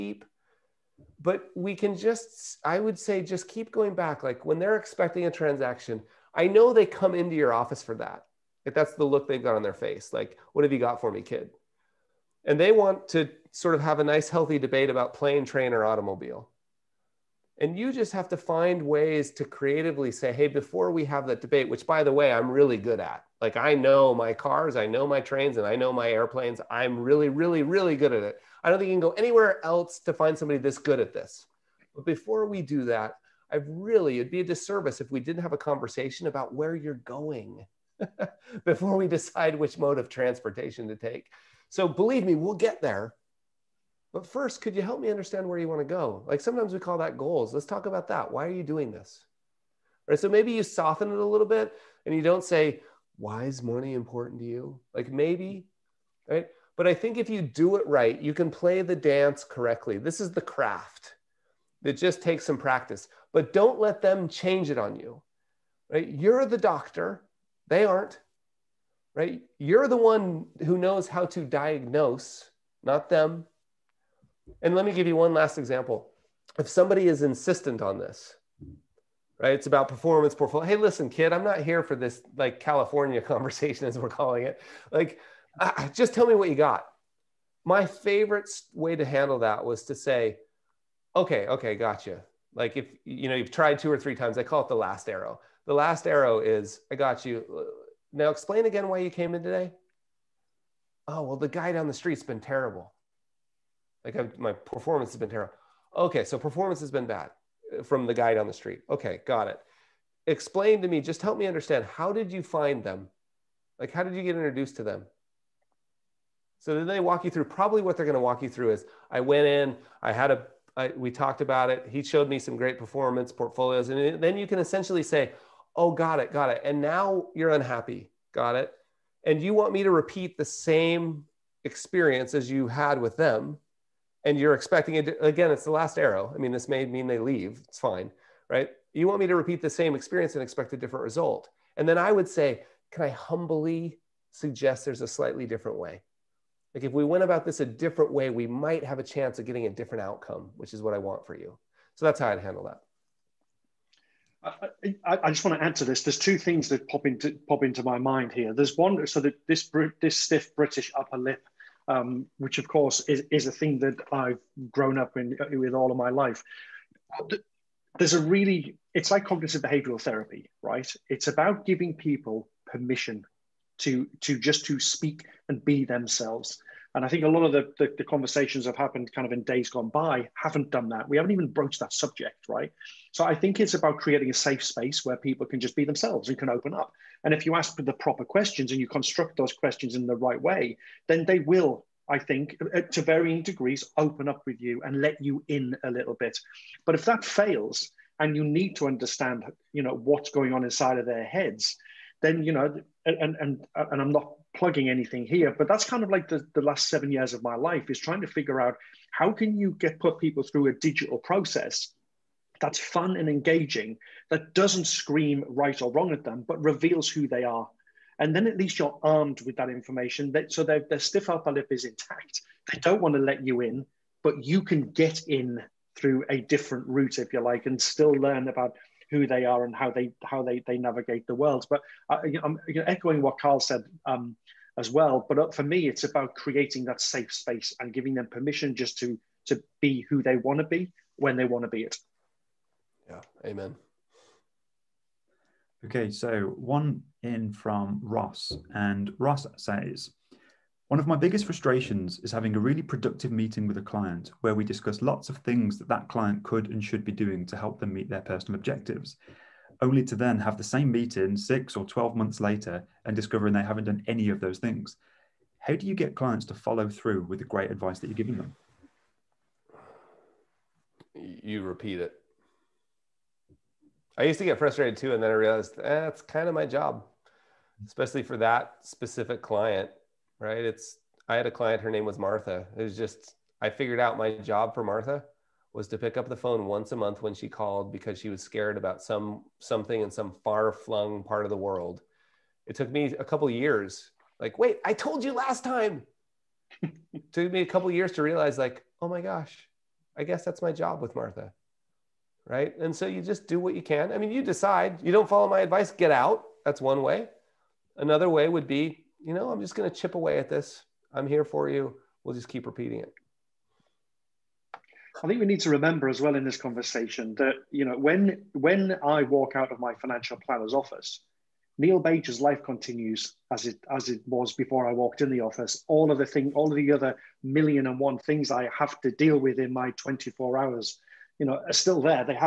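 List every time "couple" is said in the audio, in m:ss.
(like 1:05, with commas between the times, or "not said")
4:53, 4:57.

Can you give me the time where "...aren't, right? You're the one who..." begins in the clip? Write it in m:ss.
1:07.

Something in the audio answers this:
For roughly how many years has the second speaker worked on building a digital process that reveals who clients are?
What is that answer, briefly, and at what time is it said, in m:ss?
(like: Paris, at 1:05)
7, at 3:26.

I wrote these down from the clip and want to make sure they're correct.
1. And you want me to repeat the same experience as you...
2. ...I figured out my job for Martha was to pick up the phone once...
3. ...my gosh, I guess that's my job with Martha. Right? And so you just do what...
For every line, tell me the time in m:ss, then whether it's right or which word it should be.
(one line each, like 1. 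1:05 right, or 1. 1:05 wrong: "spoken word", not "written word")
1. 2:09 right
2. 4:43 right
3. 4:59 right.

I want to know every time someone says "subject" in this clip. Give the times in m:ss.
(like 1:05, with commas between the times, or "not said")
3:01.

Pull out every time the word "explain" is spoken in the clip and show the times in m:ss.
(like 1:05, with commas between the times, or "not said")
1:38, 1:50.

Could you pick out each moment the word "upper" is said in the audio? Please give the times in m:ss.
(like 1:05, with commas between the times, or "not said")
2:40, 3:41.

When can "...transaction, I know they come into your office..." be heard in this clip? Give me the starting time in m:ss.
0:05.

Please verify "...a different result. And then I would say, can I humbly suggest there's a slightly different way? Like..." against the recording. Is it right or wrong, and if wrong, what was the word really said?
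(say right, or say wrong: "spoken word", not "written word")
right.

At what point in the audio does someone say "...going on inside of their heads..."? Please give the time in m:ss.
3:20.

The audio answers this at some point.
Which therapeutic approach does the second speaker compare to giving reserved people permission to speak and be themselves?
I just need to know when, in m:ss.
2:49.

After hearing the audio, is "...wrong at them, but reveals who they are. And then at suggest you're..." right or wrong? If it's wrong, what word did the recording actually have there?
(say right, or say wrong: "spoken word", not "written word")
wrong: "least", not "suggest".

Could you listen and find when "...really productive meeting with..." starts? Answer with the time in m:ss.
4:12.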